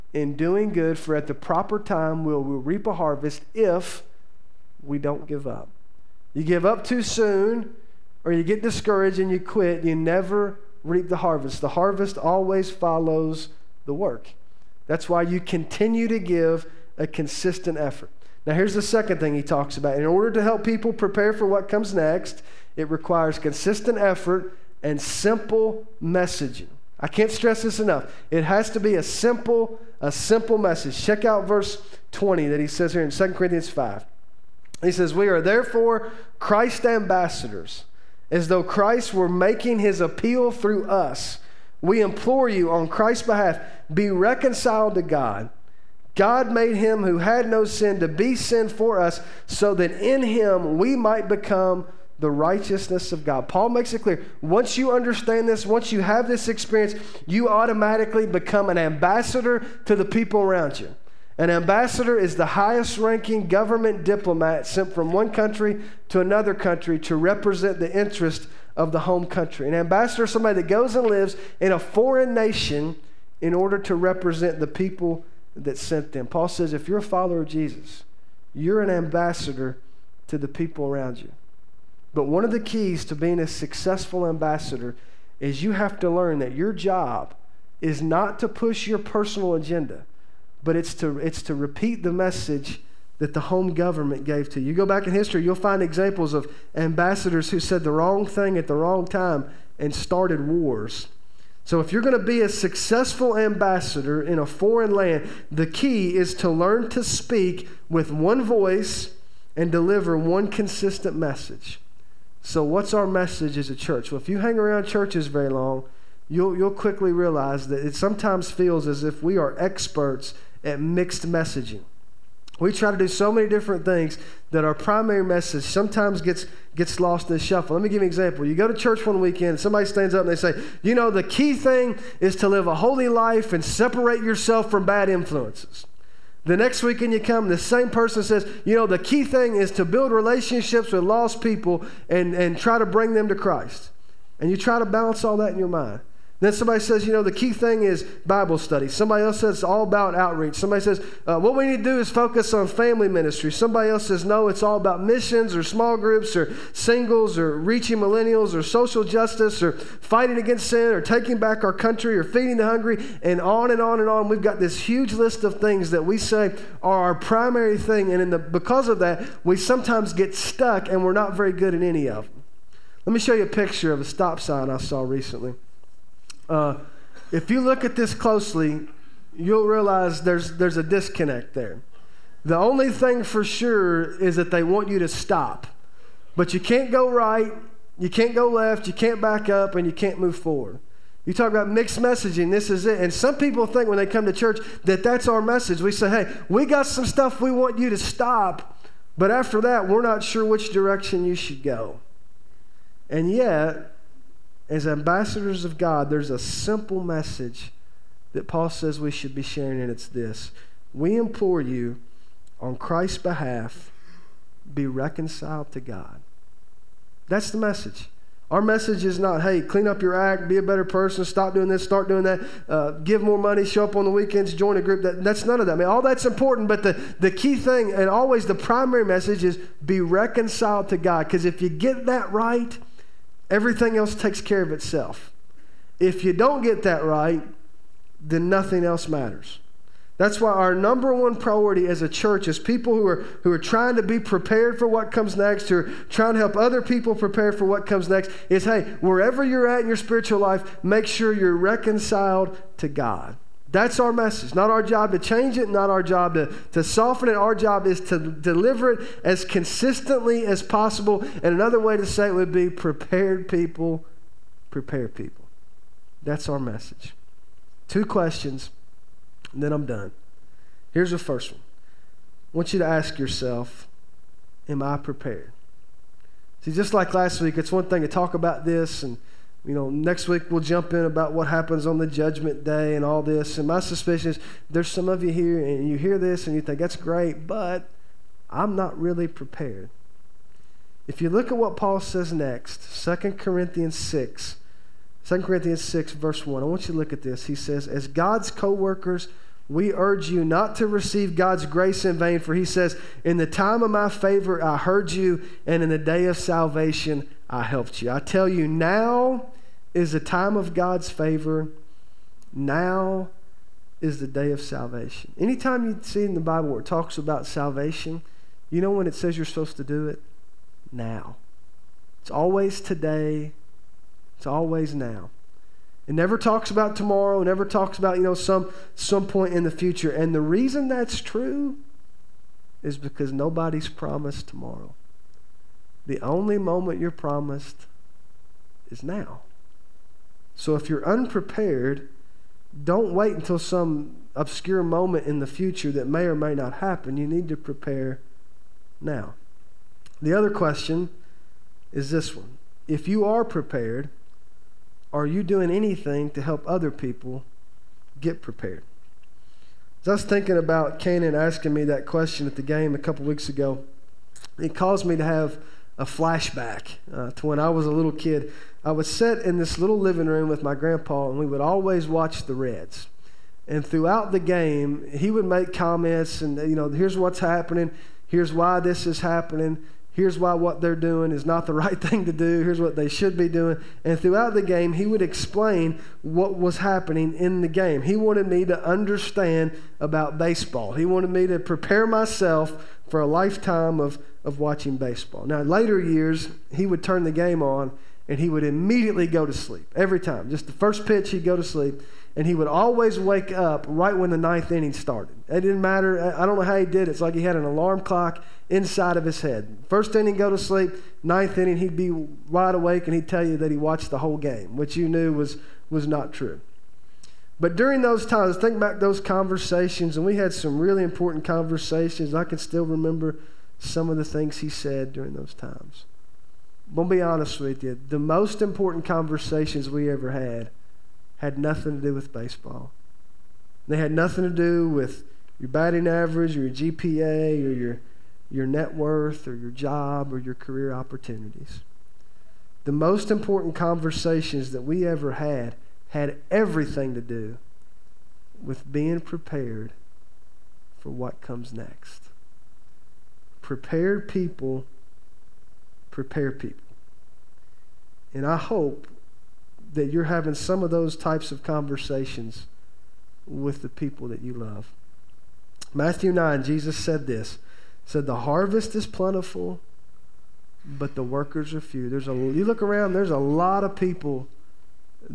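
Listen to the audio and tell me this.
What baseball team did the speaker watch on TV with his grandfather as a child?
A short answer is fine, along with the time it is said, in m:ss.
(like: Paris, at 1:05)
The Reds, at 6:12.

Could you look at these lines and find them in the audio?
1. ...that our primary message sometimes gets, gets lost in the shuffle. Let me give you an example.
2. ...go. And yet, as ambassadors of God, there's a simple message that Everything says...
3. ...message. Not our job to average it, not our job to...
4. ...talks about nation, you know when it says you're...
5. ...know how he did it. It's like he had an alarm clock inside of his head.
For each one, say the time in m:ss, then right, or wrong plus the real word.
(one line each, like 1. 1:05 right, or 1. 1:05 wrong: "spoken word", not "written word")
1. 2:04 right
2. 3:21 wrong: "Paul", not "Everything"
3. 4:14 wrong: "change", not "average"
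4. 5:16 wrong: "salvation", not "nation"
5. 6:46 right.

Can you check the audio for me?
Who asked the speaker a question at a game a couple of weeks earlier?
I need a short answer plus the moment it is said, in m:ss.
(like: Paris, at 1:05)
Canaan, at 6:00.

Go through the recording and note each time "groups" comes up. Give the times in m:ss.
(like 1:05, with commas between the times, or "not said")
2:35, 3:44.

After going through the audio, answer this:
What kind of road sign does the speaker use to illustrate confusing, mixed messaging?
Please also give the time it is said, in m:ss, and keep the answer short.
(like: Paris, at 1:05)
Stop sign, at 2:54.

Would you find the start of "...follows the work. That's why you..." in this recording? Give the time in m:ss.
0:12.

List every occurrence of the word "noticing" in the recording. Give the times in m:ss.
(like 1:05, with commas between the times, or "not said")
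not said.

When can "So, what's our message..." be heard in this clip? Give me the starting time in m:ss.
1:52.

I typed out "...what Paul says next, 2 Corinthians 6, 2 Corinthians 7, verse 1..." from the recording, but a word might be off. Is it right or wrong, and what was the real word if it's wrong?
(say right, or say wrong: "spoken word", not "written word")
wrong: "6", not "7".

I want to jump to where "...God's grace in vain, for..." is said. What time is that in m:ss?
5:01.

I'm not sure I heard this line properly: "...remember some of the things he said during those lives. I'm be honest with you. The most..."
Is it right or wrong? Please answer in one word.
wrong.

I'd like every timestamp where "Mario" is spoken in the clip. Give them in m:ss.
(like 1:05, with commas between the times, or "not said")
not said.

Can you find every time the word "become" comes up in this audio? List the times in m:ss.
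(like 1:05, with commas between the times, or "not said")
0:51, 0:58.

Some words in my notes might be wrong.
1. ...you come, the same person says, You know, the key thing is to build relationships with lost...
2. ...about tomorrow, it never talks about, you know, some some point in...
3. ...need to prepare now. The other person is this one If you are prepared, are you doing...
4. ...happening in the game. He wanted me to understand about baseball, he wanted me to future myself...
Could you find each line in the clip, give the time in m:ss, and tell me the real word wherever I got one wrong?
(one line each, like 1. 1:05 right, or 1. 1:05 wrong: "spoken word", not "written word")
1. 2:17 right
2. 5:26 right
3. 5:47 wrong: "question", not "person"
4. 6:26 wrong: "prepare", not "future".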